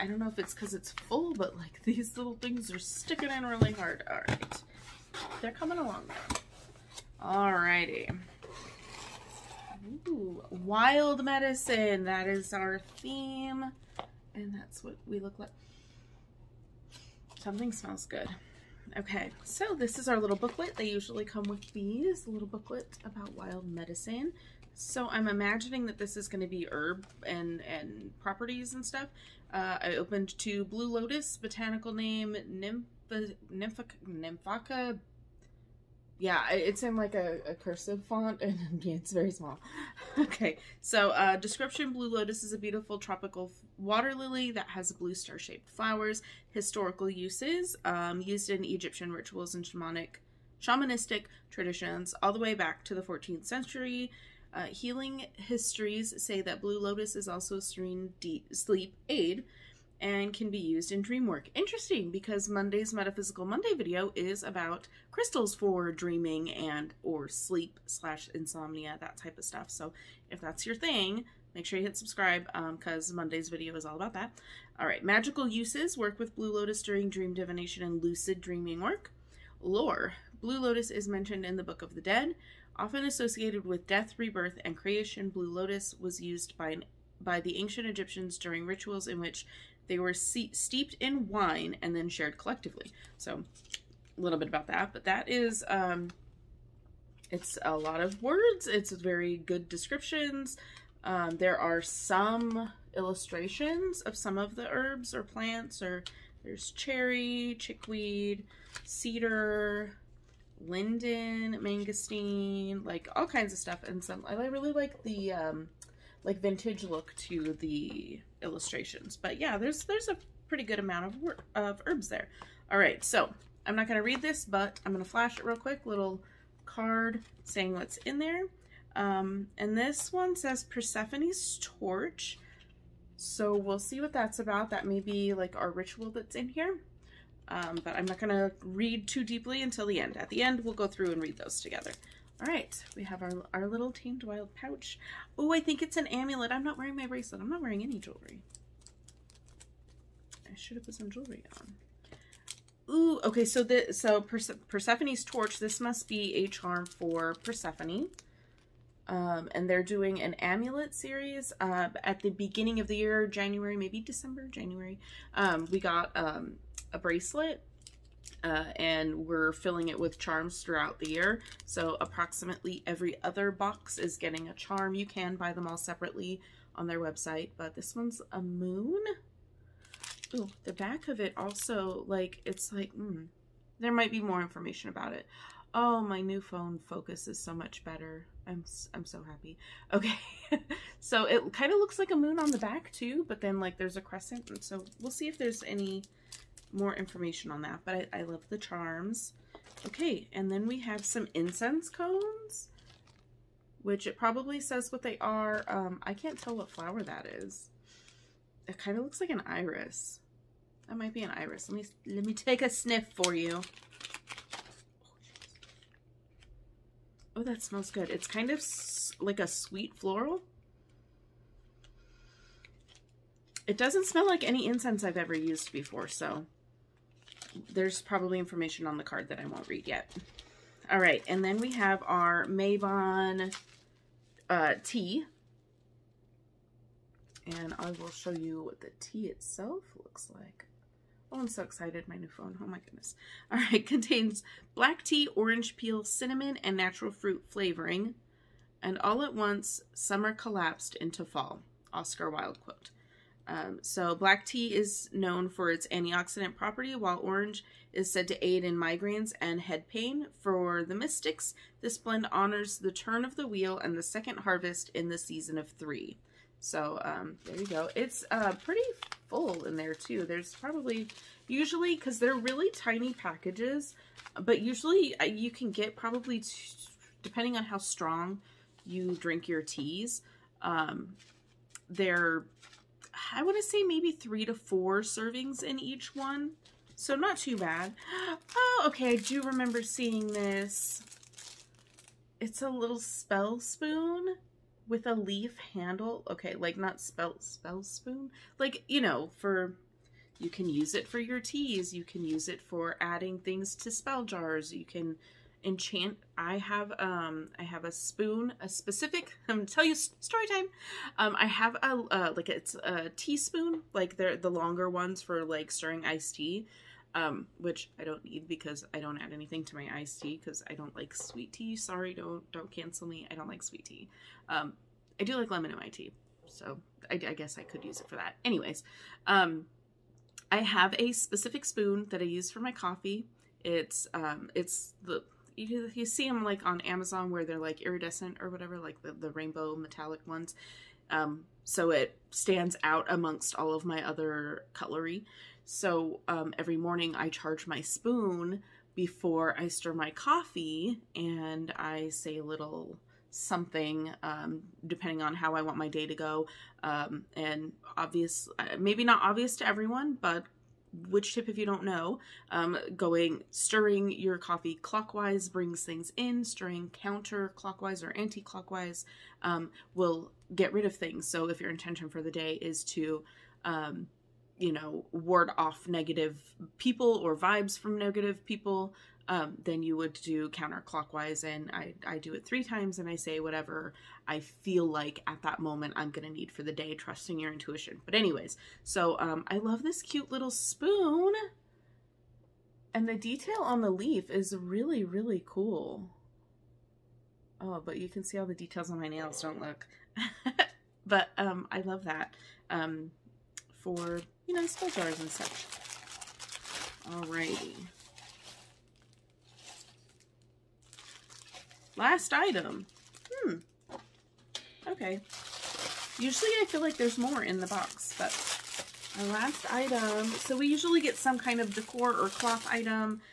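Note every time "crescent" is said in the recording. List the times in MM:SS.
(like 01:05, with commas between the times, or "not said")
03:14.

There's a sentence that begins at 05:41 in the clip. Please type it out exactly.
Um, so it stands out amongst all of my other cutlery.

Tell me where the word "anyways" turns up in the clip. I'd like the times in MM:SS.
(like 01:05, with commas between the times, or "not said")
05:28, 06:28.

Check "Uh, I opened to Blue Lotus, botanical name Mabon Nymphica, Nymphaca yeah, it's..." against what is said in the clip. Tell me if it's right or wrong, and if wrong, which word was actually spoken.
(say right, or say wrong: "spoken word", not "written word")
wrong: "Nymph", not "Mabon".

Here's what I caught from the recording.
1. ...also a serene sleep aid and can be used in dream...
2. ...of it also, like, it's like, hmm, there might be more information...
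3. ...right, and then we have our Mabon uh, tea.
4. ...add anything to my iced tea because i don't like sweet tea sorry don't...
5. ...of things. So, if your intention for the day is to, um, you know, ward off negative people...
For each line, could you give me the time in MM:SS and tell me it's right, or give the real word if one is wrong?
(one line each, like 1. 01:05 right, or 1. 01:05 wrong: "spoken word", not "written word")
1. 00:57 right
2. 03:01 right
3. 03:50 right
4. 05:19 right
5. 06:10 right.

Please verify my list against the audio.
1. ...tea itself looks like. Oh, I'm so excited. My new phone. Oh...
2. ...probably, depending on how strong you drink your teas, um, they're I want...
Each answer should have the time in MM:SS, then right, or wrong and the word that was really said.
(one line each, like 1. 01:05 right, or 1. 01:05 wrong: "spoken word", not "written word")
1. 03:58 right
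2. 04:35 right.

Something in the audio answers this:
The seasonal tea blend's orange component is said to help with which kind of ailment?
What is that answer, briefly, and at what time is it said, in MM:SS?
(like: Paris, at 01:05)
migraines, at 04:18.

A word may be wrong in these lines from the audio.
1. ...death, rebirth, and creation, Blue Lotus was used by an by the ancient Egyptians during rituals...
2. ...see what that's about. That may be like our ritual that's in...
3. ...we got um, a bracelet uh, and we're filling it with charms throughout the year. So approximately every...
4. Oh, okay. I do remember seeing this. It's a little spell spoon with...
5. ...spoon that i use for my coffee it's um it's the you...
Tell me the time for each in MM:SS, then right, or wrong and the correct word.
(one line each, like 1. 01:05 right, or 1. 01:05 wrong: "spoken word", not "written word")
1. 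01:23 right
2. 02:13 right
3. 02:45 right
4. 04:48 right
5. 05:31 right.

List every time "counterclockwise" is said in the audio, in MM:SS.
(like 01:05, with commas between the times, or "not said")
06:06, 06:20.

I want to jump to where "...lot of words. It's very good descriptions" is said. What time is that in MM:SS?
01:37.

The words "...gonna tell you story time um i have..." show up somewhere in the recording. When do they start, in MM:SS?
05:09.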